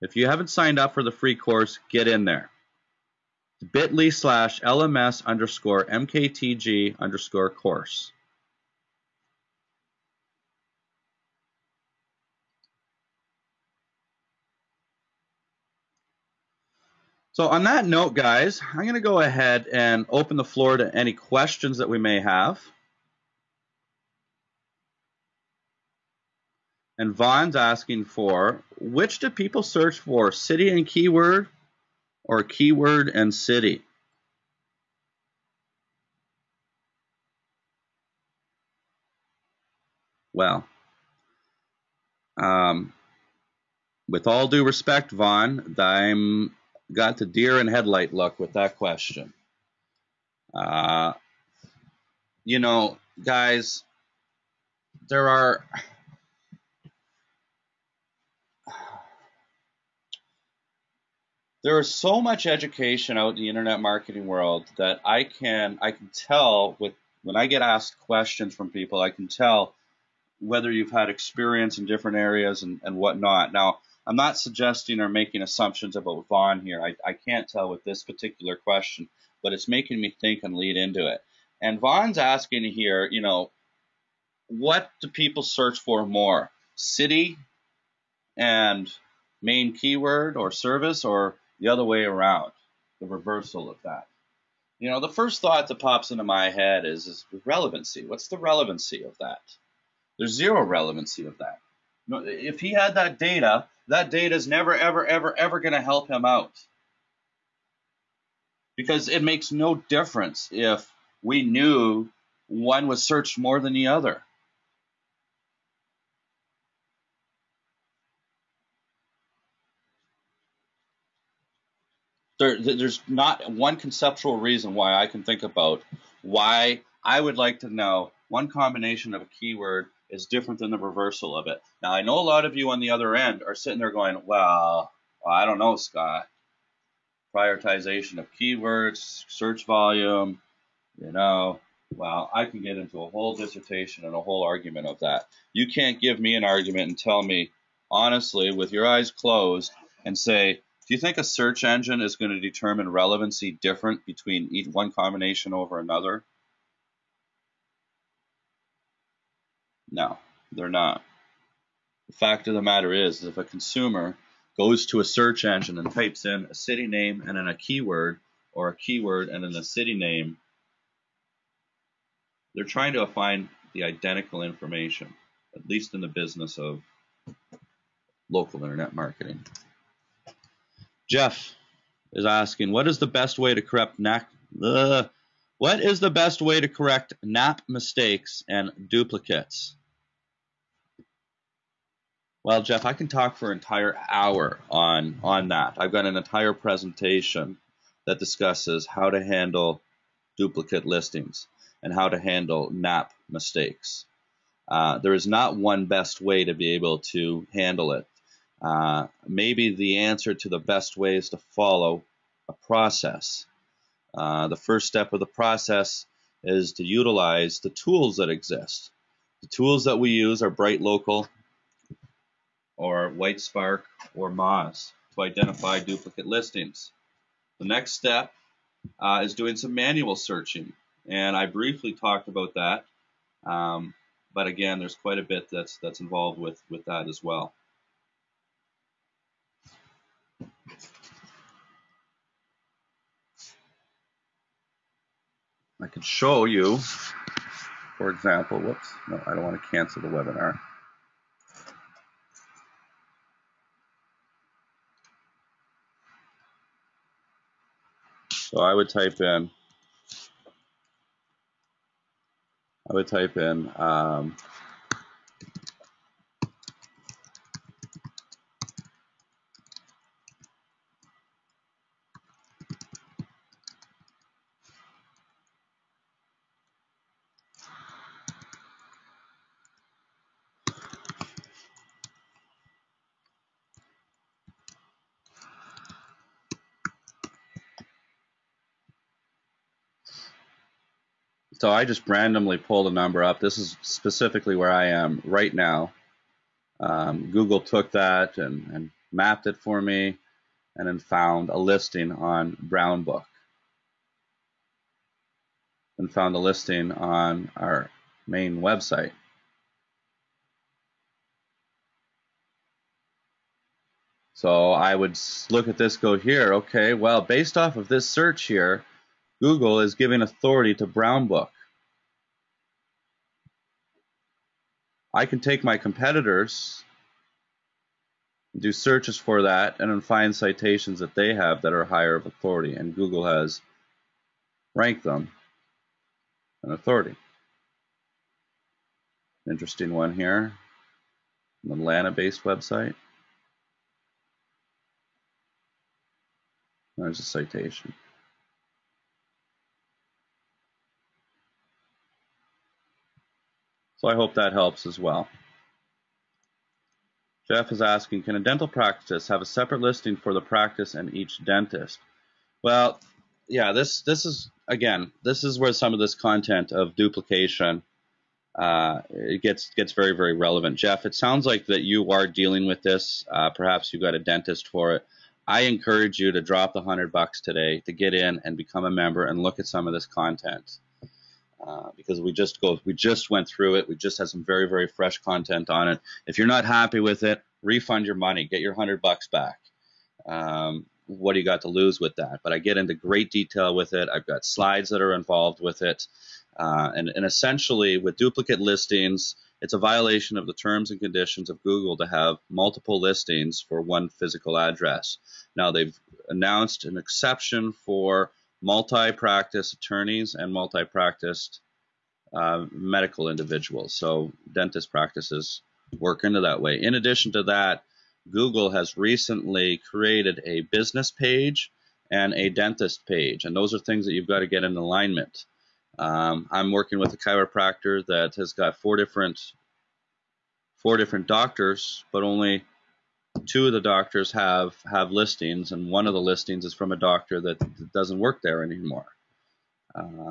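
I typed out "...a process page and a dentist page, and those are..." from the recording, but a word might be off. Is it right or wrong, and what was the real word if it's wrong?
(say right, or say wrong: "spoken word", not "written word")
wrong: "business", not "process".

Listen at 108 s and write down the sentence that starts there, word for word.
Because it makes no difference if we knew one was searched more than the other.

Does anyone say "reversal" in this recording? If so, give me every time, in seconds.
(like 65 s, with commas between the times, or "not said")
93 s, 130 s.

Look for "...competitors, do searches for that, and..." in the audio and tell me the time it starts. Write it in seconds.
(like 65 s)
325 s.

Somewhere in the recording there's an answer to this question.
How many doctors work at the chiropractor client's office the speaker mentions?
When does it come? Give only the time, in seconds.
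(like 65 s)
430 s.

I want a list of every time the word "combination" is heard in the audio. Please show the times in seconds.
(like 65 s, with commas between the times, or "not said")
128 s, 154 s.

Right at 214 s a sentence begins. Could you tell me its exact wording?
Uh, the first step of the process is to utilize the tools that exist.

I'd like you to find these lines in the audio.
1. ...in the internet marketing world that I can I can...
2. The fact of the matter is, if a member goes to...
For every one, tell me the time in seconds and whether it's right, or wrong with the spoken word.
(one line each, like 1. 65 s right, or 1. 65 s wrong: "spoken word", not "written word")
1. 63 s right
2. 162 s wrong: "consumer", not "member".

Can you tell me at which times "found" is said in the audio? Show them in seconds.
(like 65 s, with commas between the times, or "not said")
300 s, 306 s.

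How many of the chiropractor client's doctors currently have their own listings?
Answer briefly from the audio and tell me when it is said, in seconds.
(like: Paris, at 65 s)
2, at 432 s.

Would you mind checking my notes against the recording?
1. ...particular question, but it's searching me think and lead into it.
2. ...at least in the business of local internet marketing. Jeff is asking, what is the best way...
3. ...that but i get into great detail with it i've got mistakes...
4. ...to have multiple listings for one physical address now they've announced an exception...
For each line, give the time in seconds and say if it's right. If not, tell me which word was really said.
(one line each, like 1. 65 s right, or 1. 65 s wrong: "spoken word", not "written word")
1. 78 s wrong: "making", not "searching"
2. 175 s right
3. 392 s wrong: "slides", not "mistakes"
4. 401 s right.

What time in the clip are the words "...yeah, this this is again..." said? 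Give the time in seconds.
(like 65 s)
363 s.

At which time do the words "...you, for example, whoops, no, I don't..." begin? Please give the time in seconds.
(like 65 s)
246 s.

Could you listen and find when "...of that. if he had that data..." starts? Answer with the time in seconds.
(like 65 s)
101 s.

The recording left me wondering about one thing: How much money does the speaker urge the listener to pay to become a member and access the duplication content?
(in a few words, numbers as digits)
$100.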